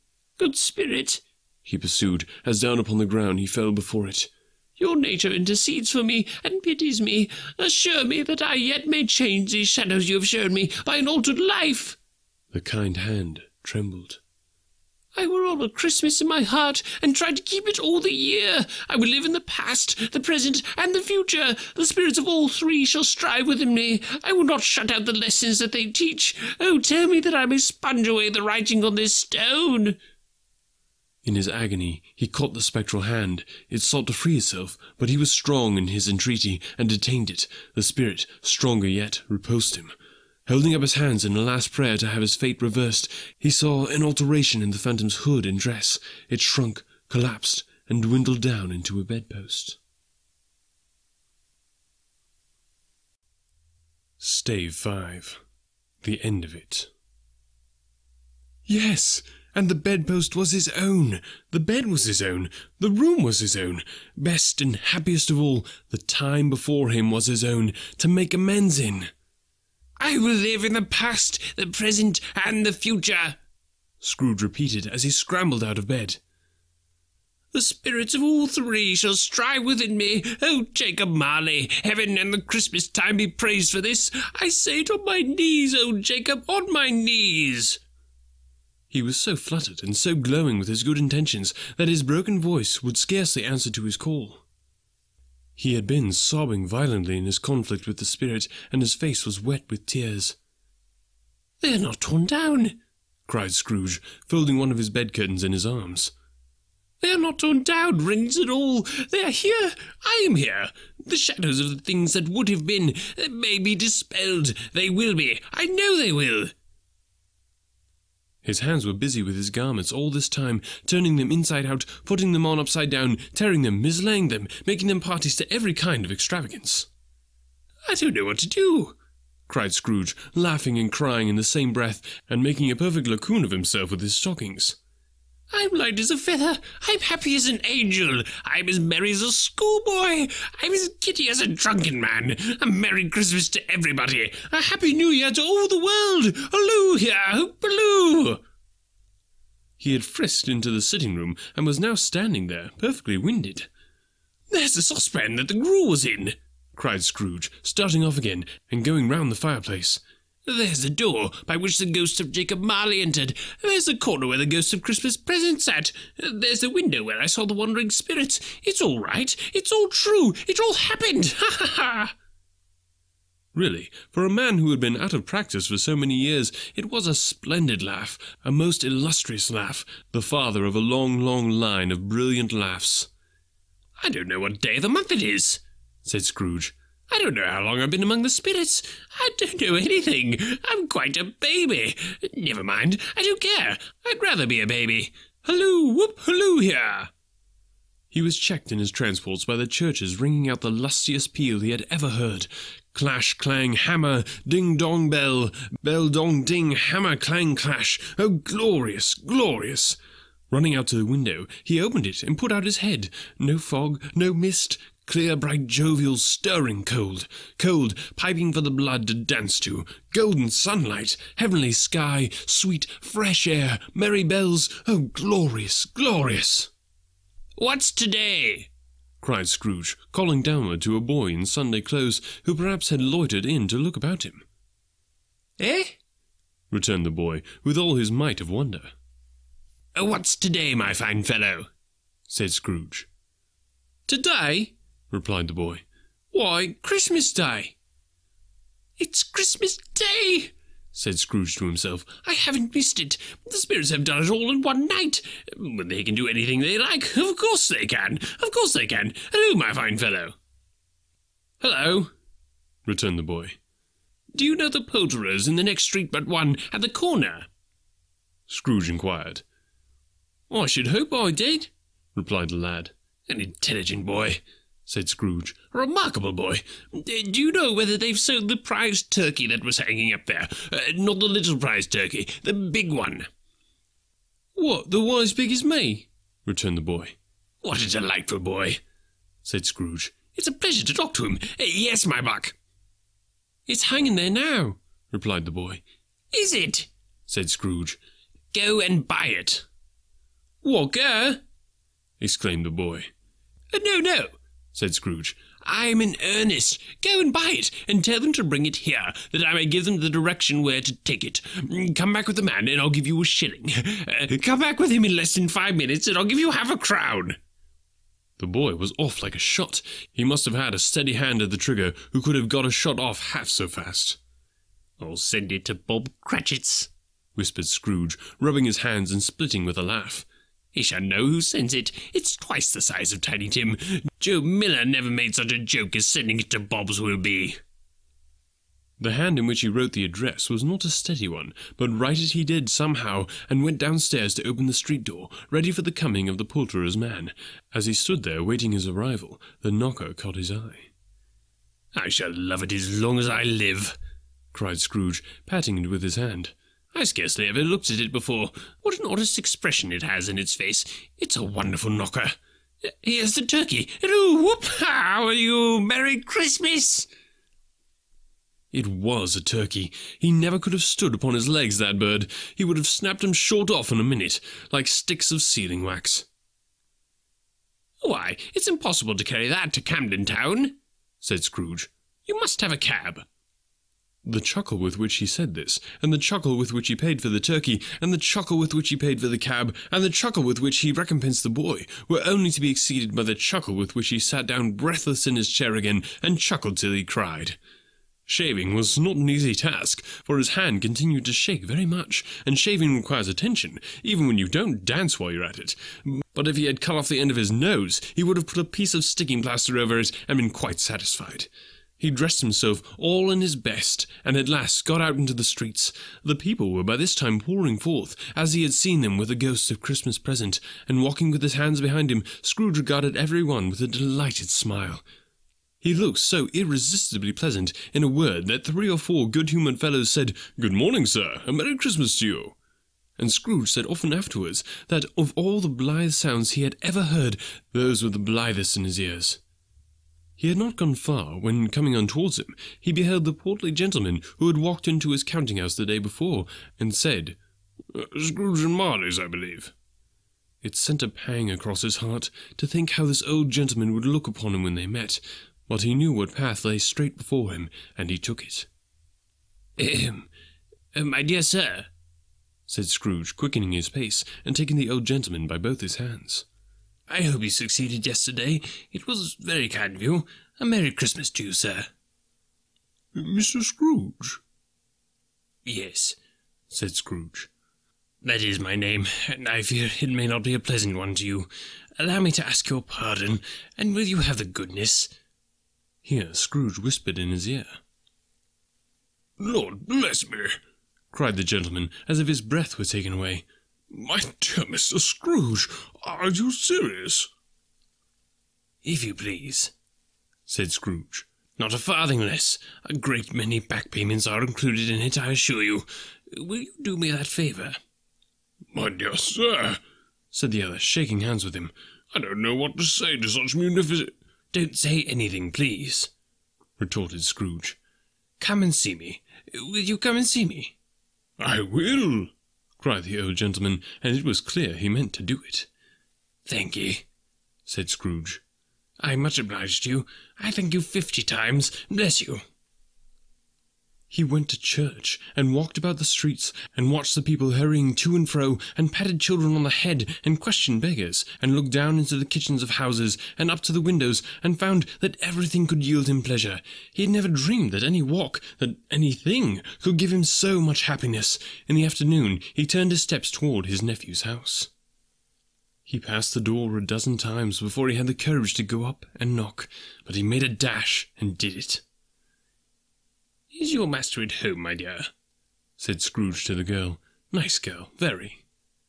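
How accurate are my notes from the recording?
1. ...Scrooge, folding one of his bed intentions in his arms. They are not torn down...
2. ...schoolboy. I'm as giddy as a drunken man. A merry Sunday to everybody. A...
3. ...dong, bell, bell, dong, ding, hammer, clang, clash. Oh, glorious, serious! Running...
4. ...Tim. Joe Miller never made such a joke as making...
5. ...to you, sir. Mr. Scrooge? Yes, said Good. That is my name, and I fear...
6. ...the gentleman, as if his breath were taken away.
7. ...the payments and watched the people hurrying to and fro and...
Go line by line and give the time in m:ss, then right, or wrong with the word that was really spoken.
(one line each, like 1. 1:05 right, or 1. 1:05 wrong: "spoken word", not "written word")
1. 1:43 wrong: "curtains", not "intentions"
2. 2:19 wrong: "Christmas", not "Sunday"
3. 3:24 wrong: "glorious", not "serious"
4. 5:33 wrong: "sending", not "making"
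5. 7:51 wrong: "Scrooge", not "Good"
6. 8:11 right
7. 8:55 wrong: "streets", not "payments".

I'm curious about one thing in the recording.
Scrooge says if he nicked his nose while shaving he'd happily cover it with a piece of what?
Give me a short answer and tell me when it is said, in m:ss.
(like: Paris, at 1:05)
Sticking plaster, at 6:49.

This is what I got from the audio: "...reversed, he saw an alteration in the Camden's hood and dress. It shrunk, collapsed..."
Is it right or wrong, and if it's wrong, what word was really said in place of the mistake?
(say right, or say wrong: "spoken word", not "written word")
wrong: "Phantom", not "Camden".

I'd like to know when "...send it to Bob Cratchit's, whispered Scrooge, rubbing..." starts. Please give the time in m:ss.
5:25.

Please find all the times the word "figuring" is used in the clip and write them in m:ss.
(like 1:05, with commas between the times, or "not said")
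not said.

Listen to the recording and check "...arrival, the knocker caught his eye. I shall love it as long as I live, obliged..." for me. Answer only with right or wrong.
wrong.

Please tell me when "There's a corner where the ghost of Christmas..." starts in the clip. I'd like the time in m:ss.
2:43.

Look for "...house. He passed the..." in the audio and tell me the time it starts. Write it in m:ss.
9:14.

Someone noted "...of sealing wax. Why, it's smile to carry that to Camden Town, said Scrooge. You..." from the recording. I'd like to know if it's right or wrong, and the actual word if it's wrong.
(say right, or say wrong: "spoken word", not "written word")
wrong: "impossible", not "smile".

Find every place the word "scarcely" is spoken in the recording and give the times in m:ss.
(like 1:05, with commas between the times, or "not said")
1:32, 5:57.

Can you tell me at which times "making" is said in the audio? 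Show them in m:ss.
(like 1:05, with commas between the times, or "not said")
2:04, 2:12.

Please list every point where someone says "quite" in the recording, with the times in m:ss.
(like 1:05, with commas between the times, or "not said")
3:10, 6:50.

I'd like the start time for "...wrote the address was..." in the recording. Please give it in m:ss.
5:39.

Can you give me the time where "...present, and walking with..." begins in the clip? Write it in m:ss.
7:00.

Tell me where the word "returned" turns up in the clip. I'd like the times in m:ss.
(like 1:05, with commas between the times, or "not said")
3:56, 4:22, 4:46.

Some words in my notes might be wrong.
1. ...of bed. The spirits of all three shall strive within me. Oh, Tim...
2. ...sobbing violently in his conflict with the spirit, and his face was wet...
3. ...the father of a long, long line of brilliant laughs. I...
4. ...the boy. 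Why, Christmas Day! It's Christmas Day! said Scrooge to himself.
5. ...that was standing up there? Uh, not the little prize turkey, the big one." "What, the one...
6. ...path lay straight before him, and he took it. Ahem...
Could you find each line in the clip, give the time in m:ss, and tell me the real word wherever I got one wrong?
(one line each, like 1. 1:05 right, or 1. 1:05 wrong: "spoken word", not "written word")
1. 1:15 wrong: "Jacob", not "Tim"
2. 1:36 right
3. 3:00 right
4. 4:05 right
5. 4:39 wrong: "hanging", not "standing"
6. 7:36 right.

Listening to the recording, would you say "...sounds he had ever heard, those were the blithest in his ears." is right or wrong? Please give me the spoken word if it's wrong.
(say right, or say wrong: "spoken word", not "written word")
right.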